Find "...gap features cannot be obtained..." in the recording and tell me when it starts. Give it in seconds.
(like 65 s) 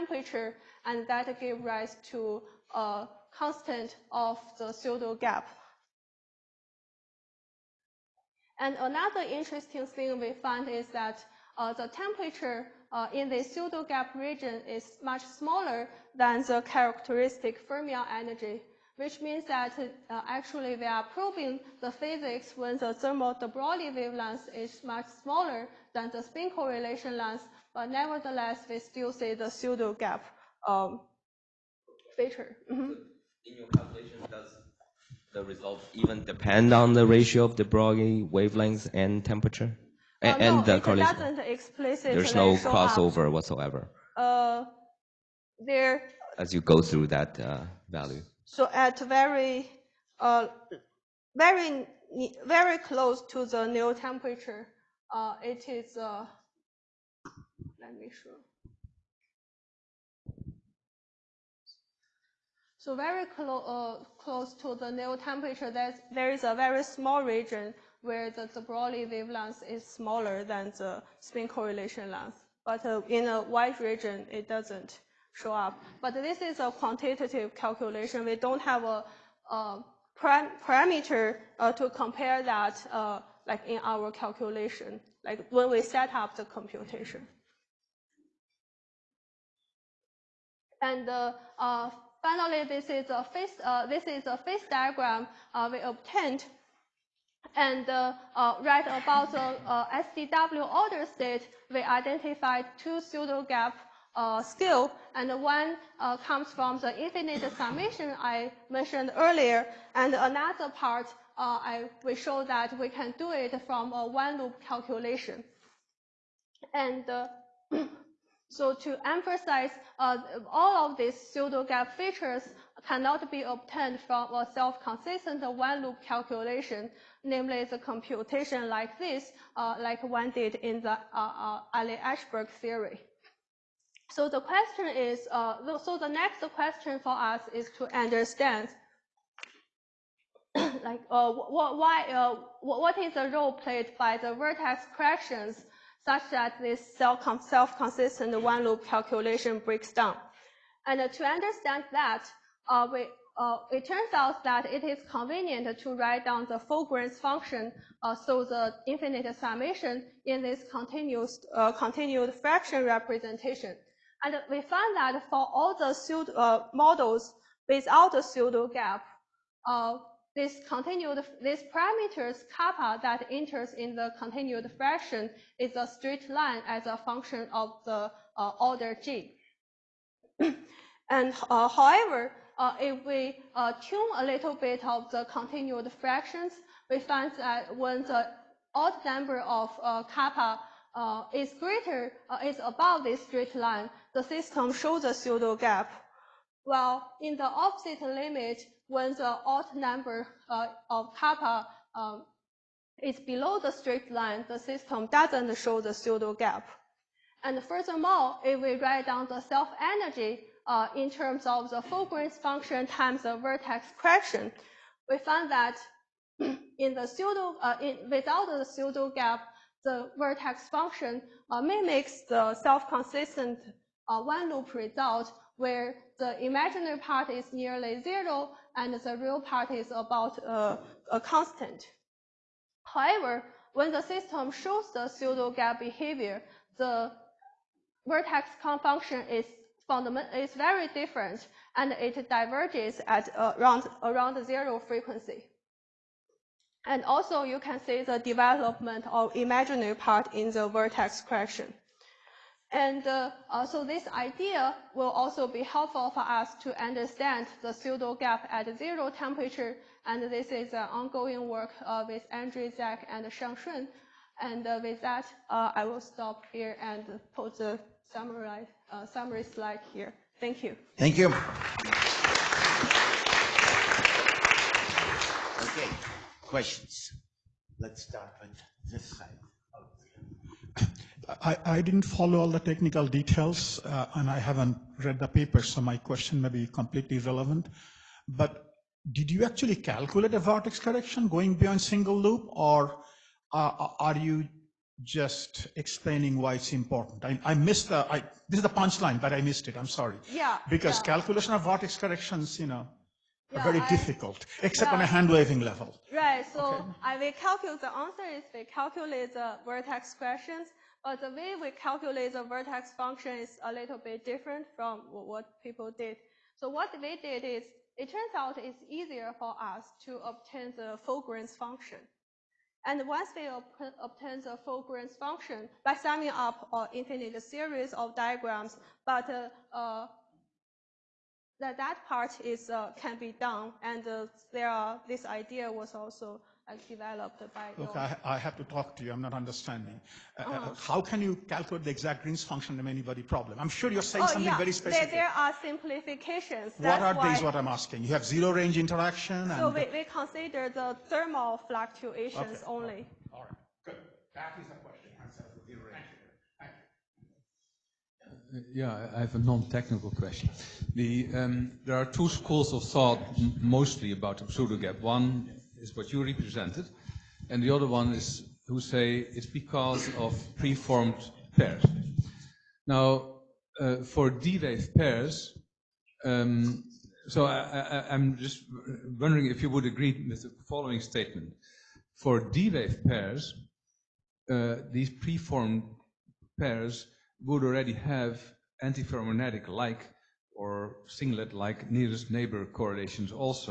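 121 s.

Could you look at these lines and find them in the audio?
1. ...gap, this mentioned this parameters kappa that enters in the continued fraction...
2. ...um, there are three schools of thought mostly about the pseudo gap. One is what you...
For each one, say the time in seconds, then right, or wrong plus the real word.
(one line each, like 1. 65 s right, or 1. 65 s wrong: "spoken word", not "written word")
1. 168 s wrong: "continued", not "mentioned"
2. 361 s wrong: "two", not "three".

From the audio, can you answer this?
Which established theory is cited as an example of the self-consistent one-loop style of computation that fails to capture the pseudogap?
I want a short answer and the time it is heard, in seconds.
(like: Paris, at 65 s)
Eliashberg theory, at 131 s.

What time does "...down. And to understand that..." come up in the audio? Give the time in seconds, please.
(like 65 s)
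149 s.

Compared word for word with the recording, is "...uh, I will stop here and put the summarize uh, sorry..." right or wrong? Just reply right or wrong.
wrong.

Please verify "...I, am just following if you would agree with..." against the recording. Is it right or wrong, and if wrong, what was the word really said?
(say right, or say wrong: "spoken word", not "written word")
wrong: "wondering", not "following".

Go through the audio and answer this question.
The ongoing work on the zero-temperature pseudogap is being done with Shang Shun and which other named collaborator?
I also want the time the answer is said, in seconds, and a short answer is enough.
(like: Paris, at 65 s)
Andrew Zach, at 262 s.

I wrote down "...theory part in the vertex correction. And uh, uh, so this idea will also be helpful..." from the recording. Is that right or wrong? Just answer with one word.
wrong.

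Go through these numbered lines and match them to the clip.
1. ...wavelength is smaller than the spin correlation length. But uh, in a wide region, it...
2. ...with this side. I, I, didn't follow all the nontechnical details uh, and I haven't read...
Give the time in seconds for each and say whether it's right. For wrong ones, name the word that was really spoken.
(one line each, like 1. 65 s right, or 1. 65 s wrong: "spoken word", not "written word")
1. 69 s right
2. 278 s wrong: "technical", not "nontechnical".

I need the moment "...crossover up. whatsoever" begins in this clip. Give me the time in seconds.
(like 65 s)
42 s.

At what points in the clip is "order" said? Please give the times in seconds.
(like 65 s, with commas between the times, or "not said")
100 s, 178 s.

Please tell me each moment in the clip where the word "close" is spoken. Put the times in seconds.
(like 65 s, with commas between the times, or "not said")
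52 s, 64 s.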